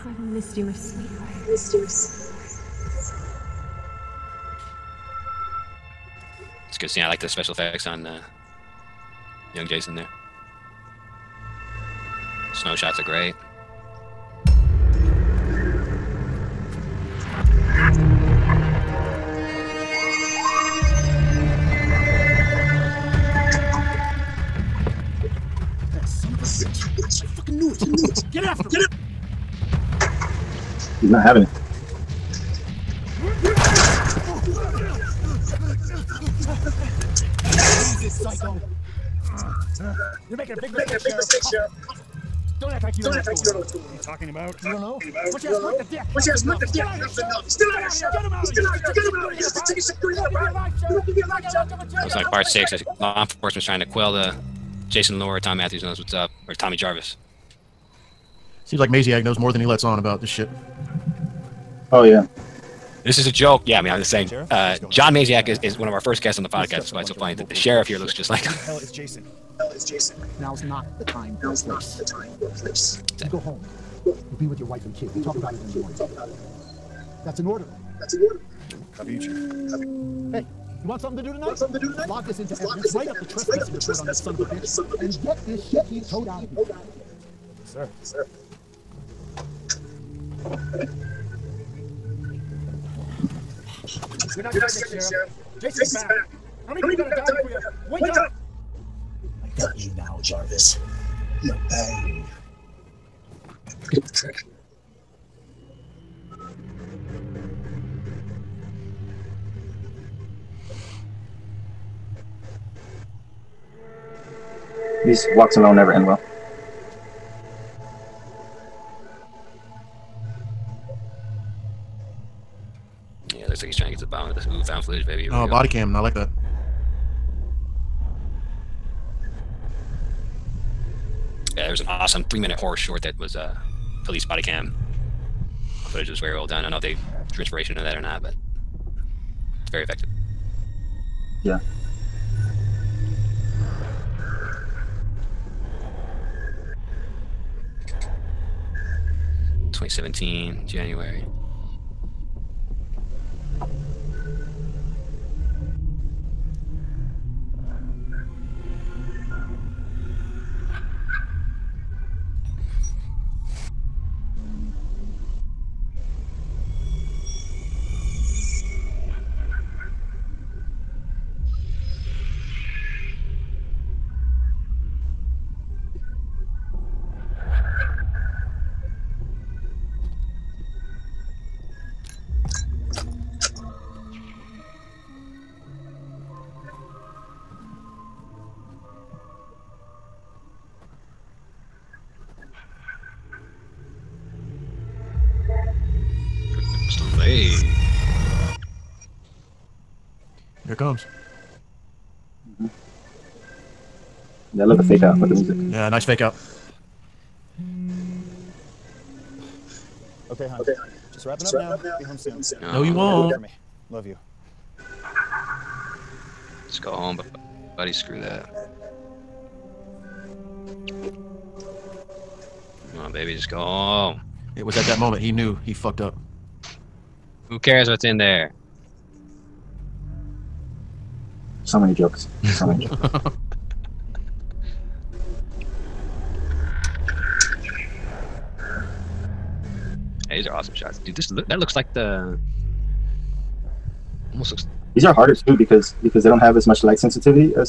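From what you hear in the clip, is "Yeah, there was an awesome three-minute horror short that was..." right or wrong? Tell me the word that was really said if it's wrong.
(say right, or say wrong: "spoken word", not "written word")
right.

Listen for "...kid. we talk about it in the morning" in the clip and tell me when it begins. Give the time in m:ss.
1:14.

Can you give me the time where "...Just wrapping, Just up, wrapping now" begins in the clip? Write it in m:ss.
3:31.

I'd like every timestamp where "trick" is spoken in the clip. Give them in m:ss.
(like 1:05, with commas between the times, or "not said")
1:44.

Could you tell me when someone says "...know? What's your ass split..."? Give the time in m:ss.
0:44.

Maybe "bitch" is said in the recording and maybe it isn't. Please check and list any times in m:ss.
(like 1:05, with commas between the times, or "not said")
1:24.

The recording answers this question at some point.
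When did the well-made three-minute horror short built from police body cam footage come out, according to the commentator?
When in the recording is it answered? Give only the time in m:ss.
2:29.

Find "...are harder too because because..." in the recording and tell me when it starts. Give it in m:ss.
4:05.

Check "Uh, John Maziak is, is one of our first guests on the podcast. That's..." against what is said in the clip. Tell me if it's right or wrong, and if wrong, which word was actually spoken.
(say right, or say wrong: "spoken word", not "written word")
right.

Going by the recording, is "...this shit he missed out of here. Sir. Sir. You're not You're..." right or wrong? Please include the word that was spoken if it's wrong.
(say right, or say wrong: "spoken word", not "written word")
wrong: "towed", not "missed".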